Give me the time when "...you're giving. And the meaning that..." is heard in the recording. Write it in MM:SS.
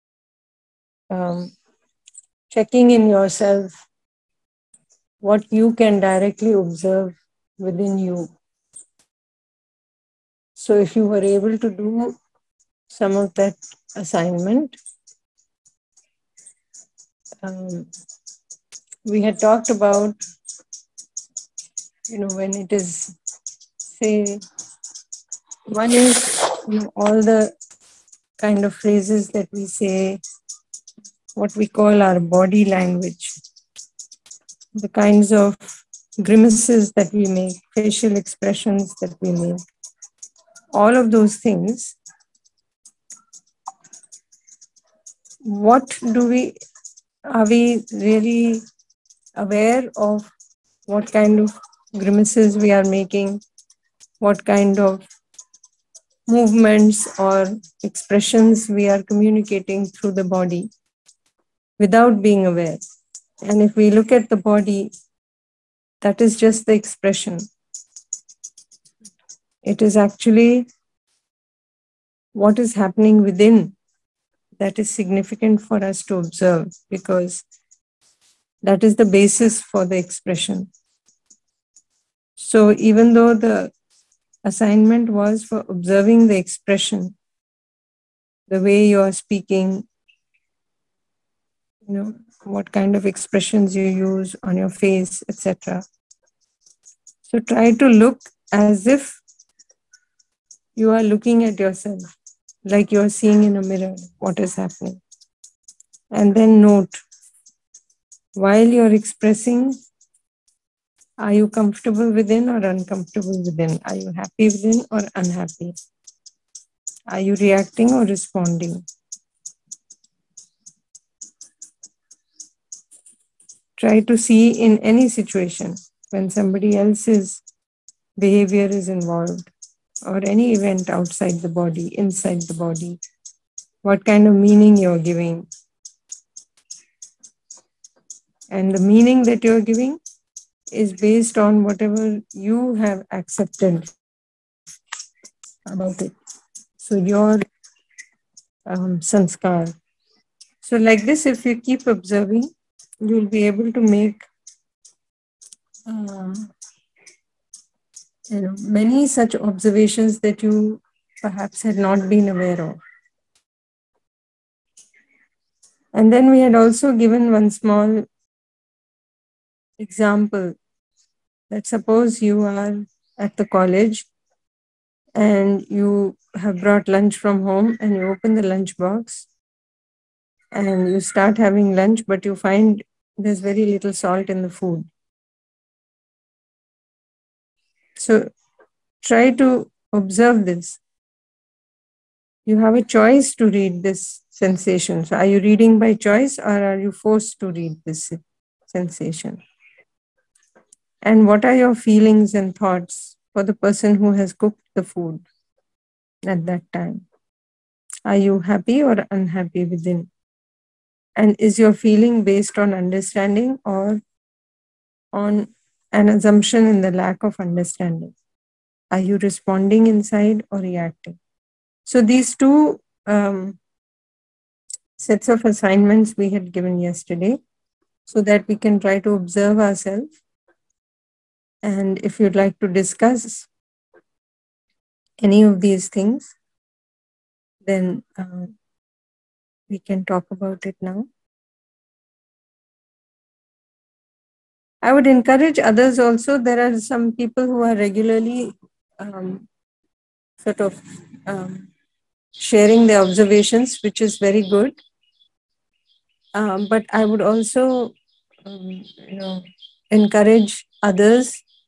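02:14.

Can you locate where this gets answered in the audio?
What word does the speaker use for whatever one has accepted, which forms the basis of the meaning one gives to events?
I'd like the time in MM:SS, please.
02:29.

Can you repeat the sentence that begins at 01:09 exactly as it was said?
It is actually what is happening within that is significant for us to observe because that is the basis for the expression.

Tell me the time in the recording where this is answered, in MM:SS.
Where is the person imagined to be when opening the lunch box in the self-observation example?
02:53.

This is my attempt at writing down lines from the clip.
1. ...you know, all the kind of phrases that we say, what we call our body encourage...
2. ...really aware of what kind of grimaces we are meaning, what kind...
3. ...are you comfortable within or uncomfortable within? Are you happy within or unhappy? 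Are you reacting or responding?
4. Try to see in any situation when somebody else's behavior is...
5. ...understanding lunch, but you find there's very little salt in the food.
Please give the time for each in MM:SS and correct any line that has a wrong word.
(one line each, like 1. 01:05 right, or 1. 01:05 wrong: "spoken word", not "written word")
1. 00:26 wrong: "language", not "encourage"
2. 00:47 wrong: "making", not "meaning"
3. 01:51 right
4. 02:03 right
5. 03:01 wrong: "having", not "understanding".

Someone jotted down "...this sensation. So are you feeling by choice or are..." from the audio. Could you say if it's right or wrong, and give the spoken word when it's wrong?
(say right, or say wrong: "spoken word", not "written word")
wrong: "reading", not "feeling".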